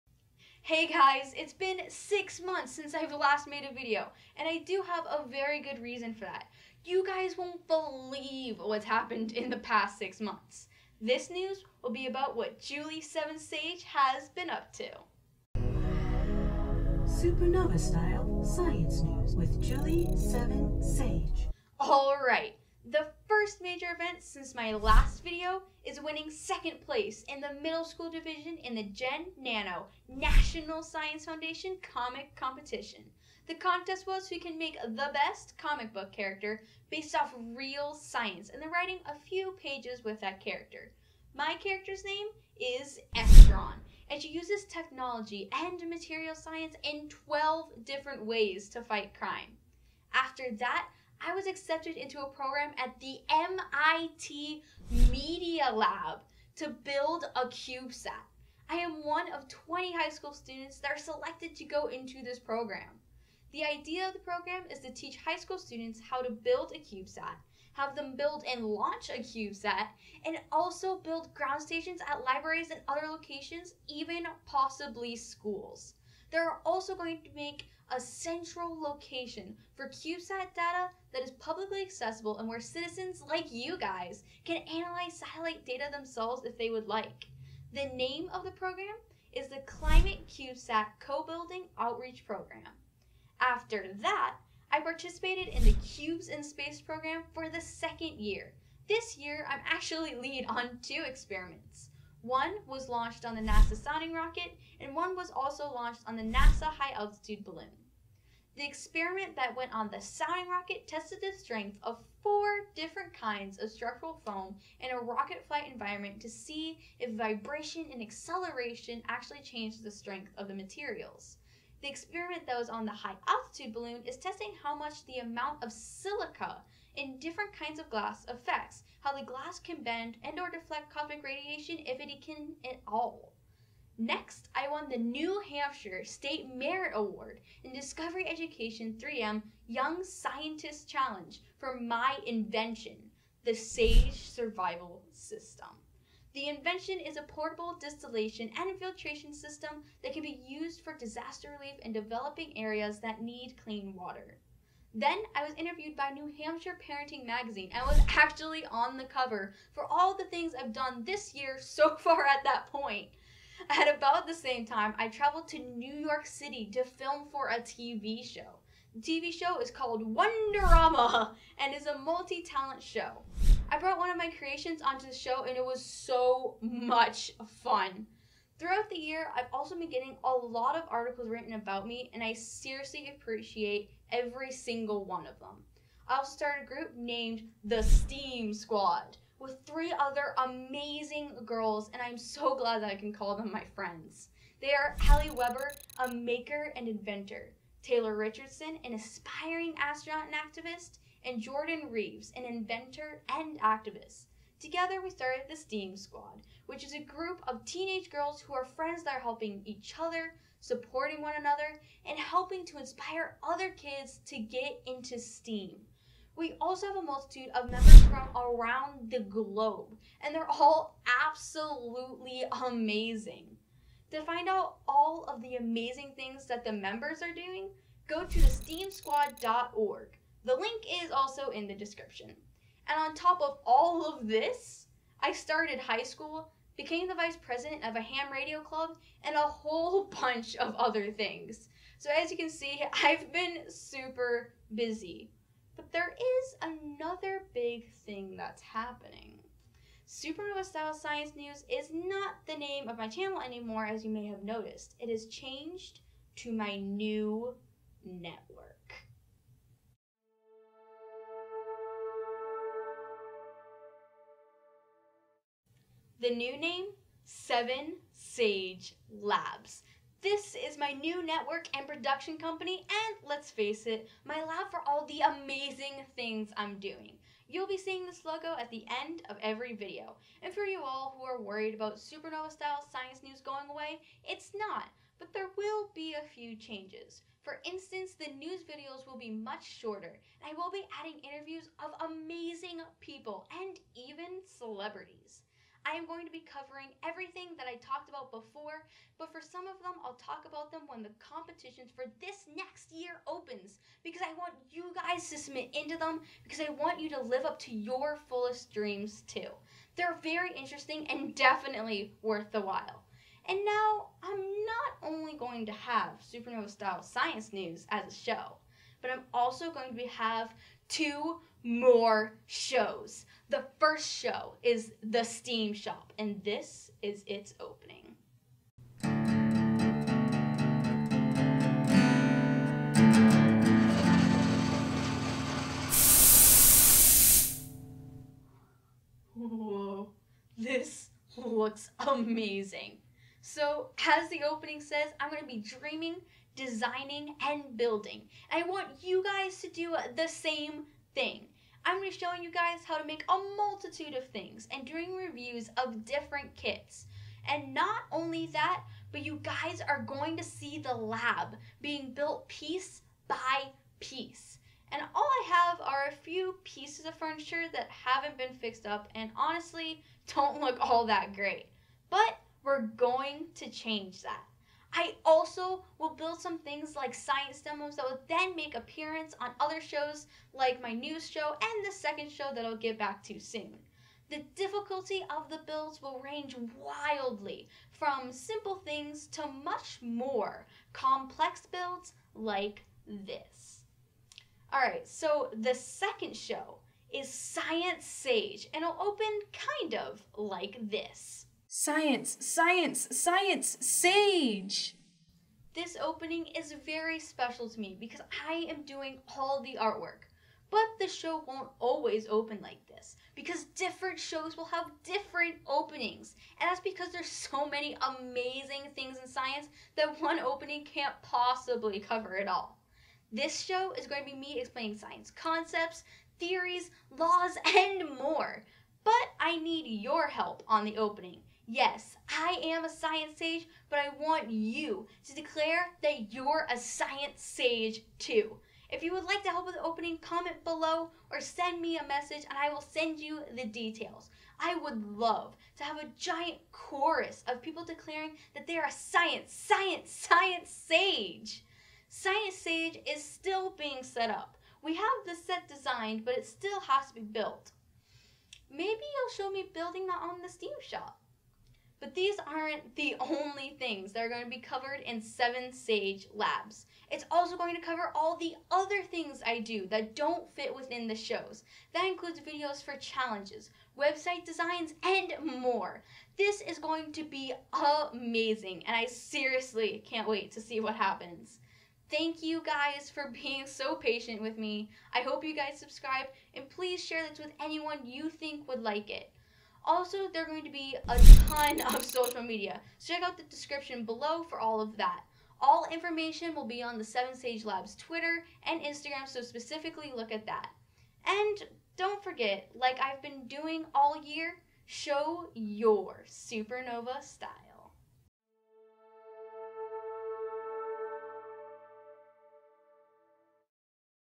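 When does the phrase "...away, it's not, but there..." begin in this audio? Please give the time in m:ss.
4:43.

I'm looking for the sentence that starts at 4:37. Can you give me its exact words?
You'll be seeing this logo at the end of every video.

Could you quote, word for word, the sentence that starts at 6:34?
All right, so the second show is Science Sage and it'll open kind of like this.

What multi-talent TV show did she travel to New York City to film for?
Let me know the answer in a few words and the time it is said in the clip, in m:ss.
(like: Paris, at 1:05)
Wonderama, at 2:50.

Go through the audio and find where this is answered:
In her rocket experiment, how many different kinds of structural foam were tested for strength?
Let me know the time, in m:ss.
1:52.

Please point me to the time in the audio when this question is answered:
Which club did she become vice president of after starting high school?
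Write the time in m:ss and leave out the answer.
3:58.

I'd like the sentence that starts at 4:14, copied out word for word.
It has changed to my new network.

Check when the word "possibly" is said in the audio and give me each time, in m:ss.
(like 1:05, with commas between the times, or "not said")
1:14, 7:01.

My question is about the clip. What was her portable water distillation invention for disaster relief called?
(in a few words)
SAGE Survival System.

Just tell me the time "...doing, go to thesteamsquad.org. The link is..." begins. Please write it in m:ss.
3:47.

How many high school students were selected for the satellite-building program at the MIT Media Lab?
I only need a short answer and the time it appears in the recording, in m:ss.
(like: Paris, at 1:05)
20, at 0:59.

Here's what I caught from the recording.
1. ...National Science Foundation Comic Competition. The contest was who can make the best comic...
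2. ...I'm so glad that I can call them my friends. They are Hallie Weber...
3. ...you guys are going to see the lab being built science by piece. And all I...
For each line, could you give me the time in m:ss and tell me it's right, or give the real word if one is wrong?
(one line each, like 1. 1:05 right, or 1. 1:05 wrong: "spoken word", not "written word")
1. 0:30 right
2. 3:12 right
3. 5:59 wrong: "piece", not "science".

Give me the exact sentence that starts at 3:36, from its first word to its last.
We also have a multitude of members from around the globe, and they're all absolutely amazing.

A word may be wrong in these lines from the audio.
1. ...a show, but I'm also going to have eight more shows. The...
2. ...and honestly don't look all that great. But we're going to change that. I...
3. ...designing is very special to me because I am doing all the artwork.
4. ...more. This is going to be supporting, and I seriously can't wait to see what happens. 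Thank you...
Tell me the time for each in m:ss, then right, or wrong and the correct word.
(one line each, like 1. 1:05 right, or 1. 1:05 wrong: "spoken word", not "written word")
1. 5:18 wrong: "two", not "eight"
2. 6:09 right
3. 6:46 wrong: "opening", not "designing"
4. 7:55 wrong: "amazing", not "supporting".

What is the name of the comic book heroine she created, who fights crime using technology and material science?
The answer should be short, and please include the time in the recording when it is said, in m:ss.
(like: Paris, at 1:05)
Estron, at 0:43.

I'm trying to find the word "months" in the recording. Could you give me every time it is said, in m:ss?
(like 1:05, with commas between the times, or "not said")
0:02, 0:10.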